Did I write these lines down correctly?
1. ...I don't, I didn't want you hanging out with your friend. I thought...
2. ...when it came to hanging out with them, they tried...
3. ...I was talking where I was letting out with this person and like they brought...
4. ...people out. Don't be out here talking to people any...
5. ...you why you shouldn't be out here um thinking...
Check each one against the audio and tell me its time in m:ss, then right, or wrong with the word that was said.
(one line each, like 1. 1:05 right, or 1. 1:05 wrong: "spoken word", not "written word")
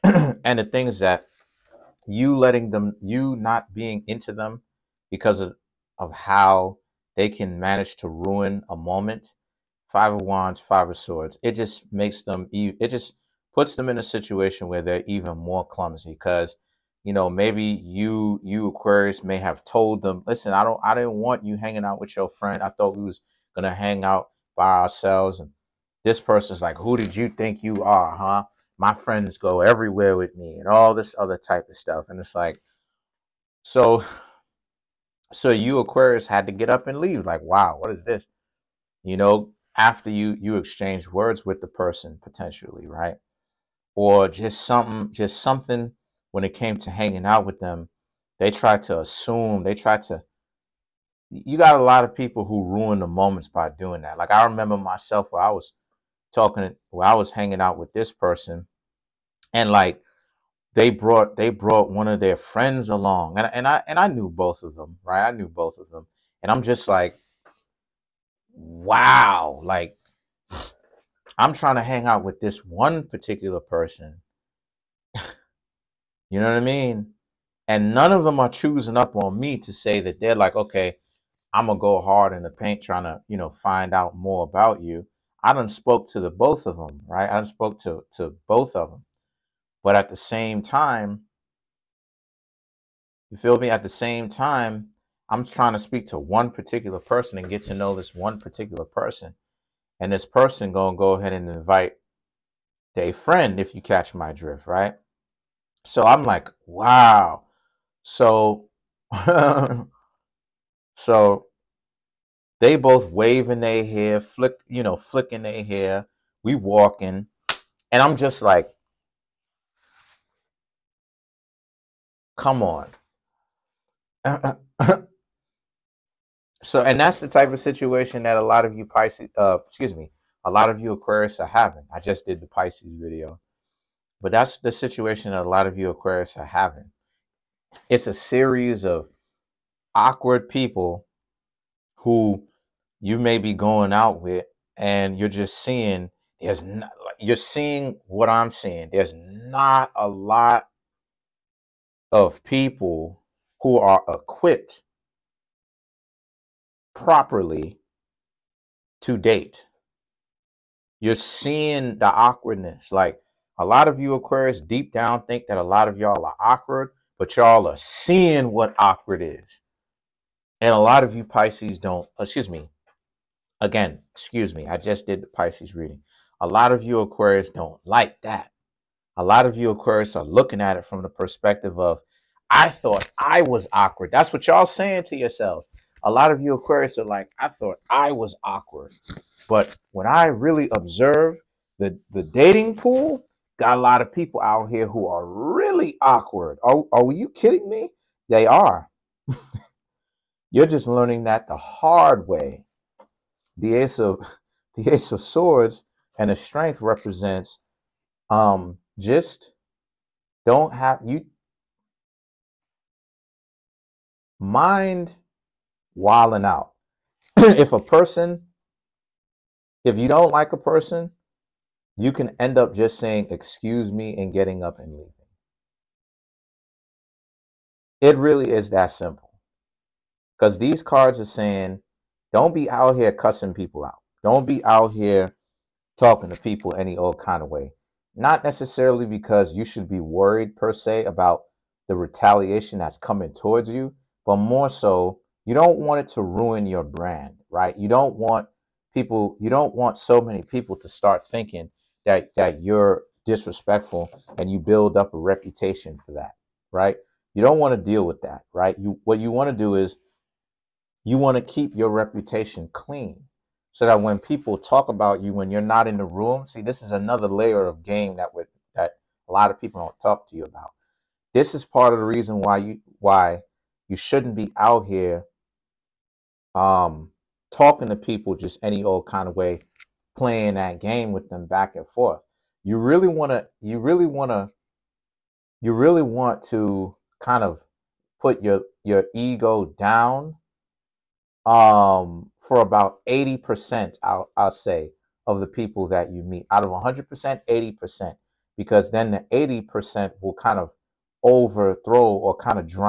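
1. 0:20 right
2. 0:46 right
3. 0:55 wrong: "hanging", not "letting"
4. 3:53 right
5. 4:32 wrong: "talking", not "thinking".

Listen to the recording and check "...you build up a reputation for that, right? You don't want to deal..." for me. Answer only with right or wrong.
right.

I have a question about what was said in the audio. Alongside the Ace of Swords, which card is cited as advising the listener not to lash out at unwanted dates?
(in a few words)
Strength.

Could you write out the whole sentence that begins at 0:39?
You know, after you you exchange words with the person potentially, right?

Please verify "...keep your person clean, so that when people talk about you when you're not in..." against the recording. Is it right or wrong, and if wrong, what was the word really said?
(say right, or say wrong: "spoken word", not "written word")
wrong: "reputation", not "person".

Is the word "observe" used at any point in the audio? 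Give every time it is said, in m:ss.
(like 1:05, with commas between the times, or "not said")
3:10.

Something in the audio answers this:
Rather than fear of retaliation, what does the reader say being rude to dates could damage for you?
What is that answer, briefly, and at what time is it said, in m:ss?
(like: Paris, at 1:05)
your brand, at 4:06.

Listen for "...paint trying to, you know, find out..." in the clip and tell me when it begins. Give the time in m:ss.
1:22.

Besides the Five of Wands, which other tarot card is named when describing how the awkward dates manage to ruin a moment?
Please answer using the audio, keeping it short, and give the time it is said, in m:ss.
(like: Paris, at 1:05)
Five of Swords, at 0:10.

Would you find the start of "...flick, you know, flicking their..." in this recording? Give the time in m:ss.
1:54.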